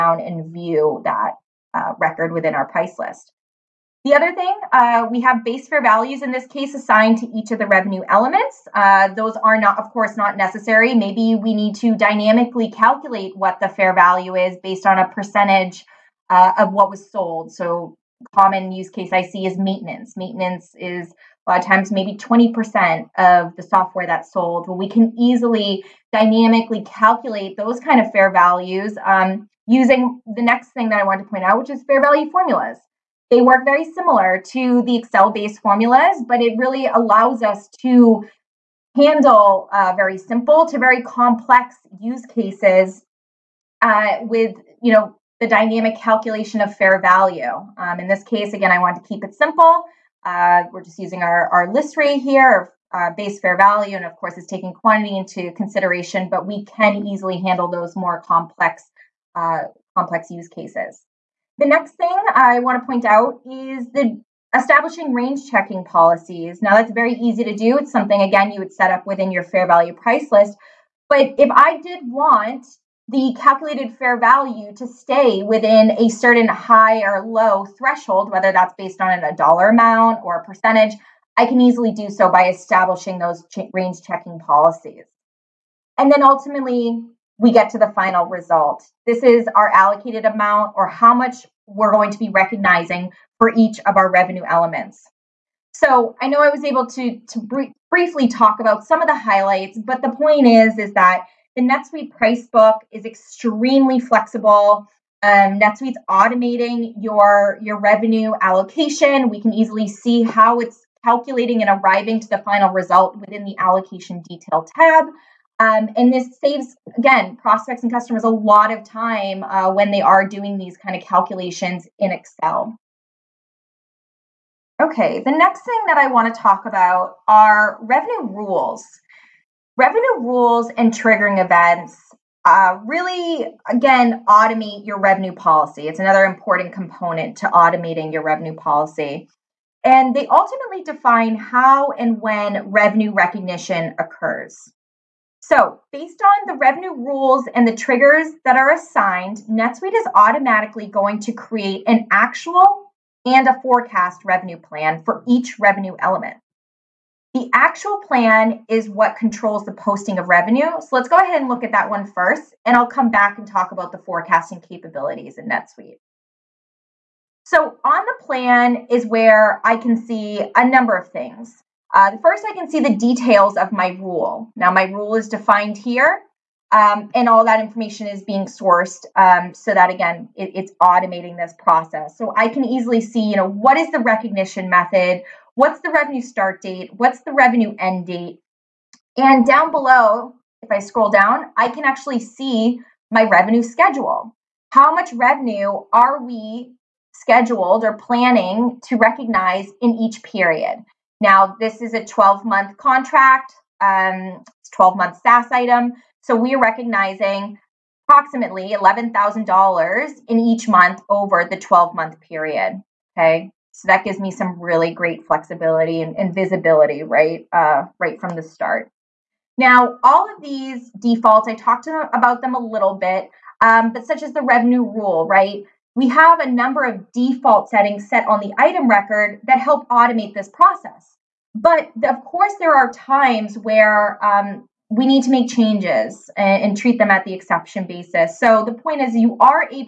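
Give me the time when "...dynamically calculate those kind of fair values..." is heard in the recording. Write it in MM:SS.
00:26.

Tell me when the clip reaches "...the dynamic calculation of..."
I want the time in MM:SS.
00:45.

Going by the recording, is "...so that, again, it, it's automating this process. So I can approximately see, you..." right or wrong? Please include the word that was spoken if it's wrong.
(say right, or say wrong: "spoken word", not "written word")
wrong: "easily", not "approximately".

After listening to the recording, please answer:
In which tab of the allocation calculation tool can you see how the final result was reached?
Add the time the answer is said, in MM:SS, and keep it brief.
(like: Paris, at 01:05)
allocation detail tab, at 01:53.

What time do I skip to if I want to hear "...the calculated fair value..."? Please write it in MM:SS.
01:13.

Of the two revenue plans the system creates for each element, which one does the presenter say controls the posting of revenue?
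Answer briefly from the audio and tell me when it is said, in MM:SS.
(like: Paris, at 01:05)
The actual plan, at 02:37.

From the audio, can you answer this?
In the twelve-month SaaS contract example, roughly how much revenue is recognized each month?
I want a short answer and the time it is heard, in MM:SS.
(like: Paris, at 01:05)
$11,000, at 03:28.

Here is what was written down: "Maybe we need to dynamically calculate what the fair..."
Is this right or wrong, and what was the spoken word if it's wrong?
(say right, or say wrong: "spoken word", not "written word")
right.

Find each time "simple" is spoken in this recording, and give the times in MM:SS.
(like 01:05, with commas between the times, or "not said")
00:40, 00:49.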